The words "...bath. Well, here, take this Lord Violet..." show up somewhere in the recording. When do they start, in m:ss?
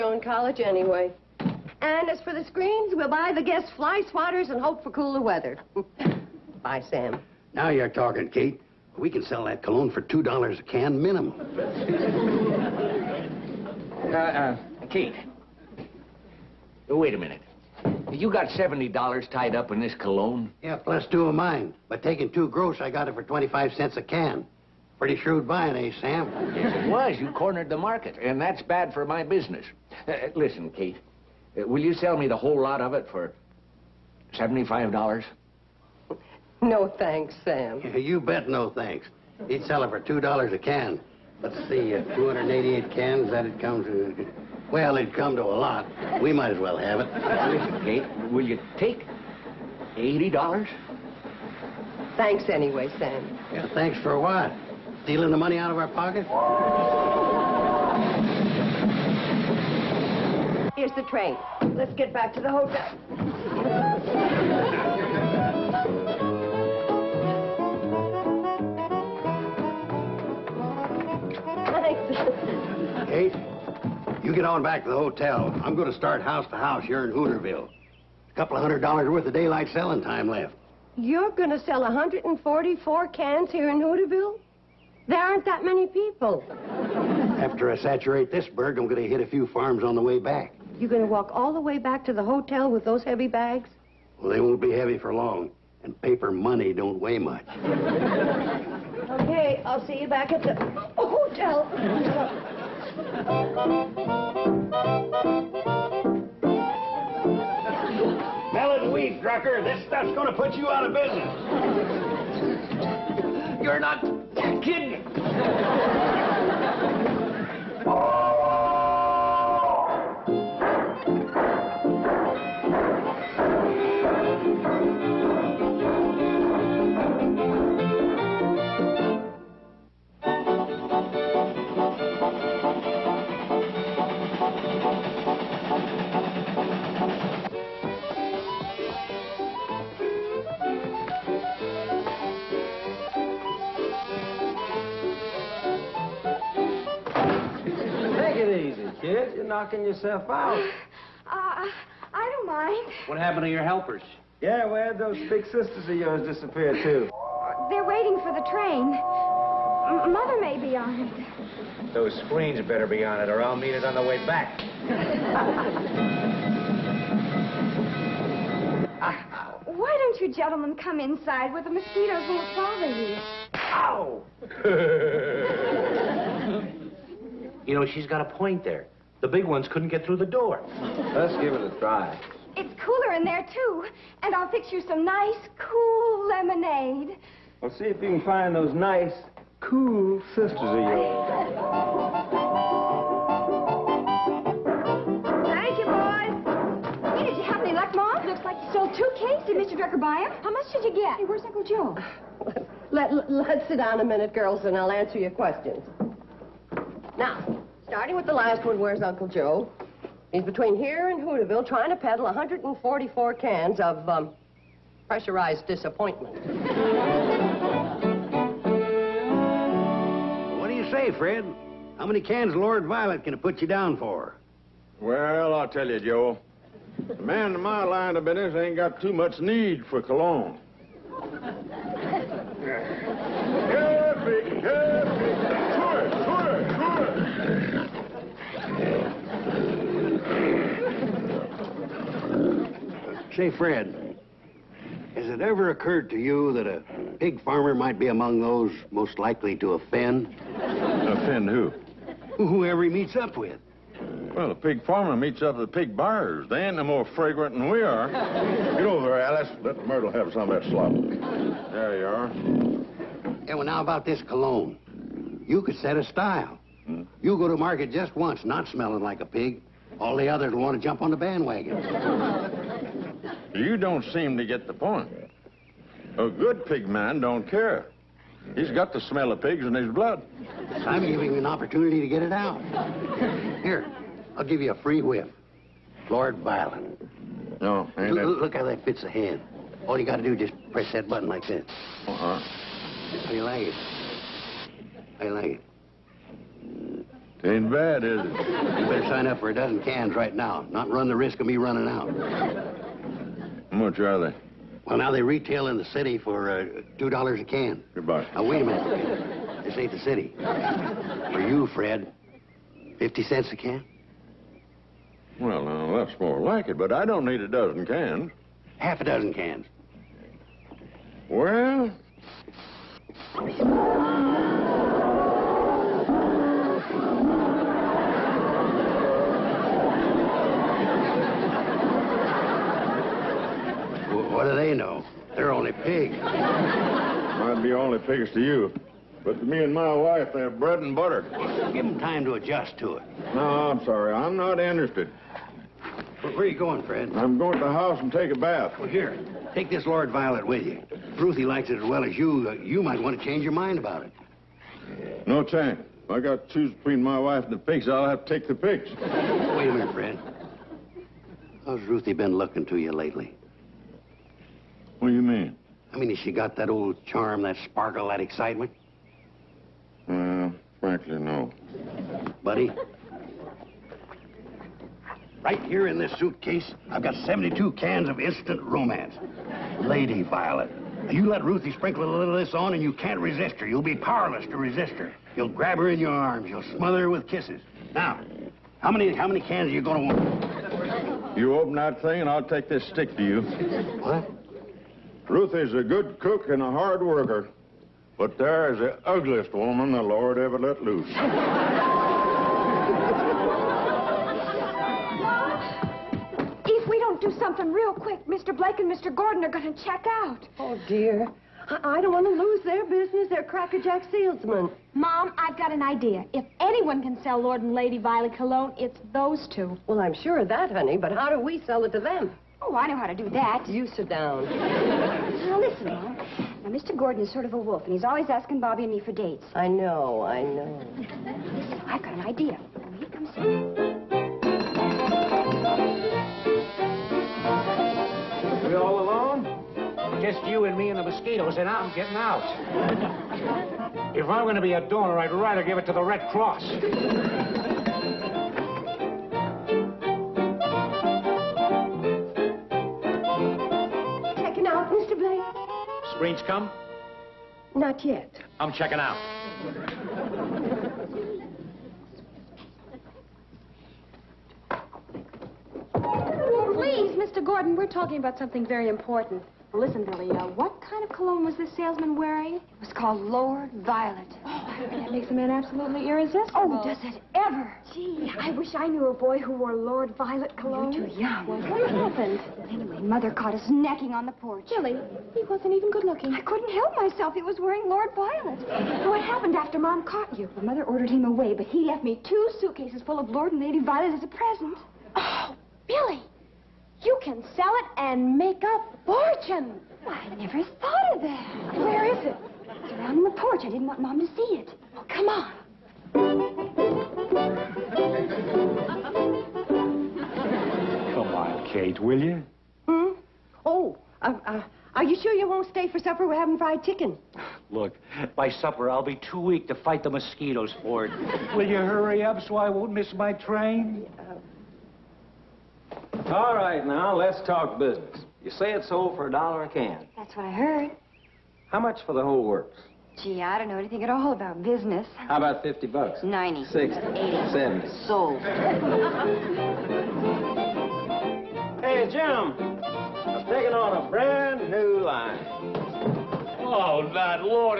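5:48.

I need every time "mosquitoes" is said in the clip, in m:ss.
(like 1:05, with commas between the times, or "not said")
2:51, 7:21, 8:40.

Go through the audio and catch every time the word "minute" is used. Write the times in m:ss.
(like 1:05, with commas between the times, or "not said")
0:17, 3:24, 5:08, 5:59.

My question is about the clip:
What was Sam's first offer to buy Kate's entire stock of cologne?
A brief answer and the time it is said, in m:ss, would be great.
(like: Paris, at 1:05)
$75, at 0:34.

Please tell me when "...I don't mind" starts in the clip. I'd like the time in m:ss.
2:31.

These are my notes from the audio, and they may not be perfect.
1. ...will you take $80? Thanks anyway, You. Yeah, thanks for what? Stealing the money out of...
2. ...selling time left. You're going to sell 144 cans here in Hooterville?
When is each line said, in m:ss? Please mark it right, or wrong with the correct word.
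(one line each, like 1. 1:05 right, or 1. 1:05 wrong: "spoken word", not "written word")
1. 0:48 wrong: "Sam", not "You"
2. 1:19 right.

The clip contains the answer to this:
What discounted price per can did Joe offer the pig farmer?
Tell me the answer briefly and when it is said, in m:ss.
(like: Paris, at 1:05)
50 cents, at 5:12.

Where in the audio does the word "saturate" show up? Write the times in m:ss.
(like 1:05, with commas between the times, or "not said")
1:27.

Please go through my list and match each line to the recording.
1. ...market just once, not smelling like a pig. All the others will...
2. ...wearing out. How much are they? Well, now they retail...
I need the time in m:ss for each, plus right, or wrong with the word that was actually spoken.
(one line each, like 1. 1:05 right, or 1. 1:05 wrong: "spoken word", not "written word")
1. 4:27 right
2. 5:01 wrong: "running", not "wearing".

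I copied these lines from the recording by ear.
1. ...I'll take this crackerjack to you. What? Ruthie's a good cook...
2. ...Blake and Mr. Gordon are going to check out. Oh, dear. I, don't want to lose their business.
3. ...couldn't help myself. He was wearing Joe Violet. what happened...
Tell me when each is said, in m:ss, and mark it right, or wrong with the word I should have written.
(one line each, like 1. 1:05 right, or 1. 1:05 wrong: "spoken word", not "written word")
1. 6:32 wrong: "stick", not "crackerjack"
2. 6:48 right
3. 8:06 wrong: "Lord", not "Joe".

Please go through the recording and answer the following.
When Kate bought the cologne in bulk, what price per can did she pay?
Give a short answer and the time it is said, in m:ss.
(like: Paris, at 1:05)
25 cents, at 0:23.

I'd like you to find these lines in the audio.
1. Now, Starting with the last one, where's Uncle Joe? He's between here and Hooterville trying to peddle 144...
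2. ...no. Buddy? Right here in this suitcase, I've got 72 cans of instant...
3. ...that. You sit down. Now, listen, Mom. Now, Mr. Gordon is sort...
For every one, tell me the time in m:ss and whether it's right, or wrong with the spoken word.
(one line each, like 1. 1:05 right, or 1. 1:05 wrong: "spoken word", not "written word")
1. 3:27 right
2. 6:11 right
3. 7:03 right.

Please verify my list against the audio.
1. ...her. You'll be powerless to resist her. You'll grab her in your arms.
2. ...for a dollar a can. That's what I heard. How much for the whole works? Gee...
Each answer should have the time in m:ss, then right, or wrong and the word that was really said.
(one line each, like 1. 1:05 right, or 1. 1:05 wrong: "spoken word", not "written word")
1. 6:23 right
2. 8:49 right.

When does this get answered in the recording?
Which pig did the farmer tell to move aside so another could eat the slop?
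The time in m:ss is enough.
4:19.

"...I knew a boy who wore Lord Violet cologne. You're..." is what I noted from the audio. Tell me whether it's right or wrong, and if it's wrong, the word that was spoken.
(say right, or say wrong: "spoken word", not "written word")
right.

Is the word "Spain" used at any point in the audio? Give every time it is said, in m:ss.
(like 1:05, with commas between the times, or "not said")
not said.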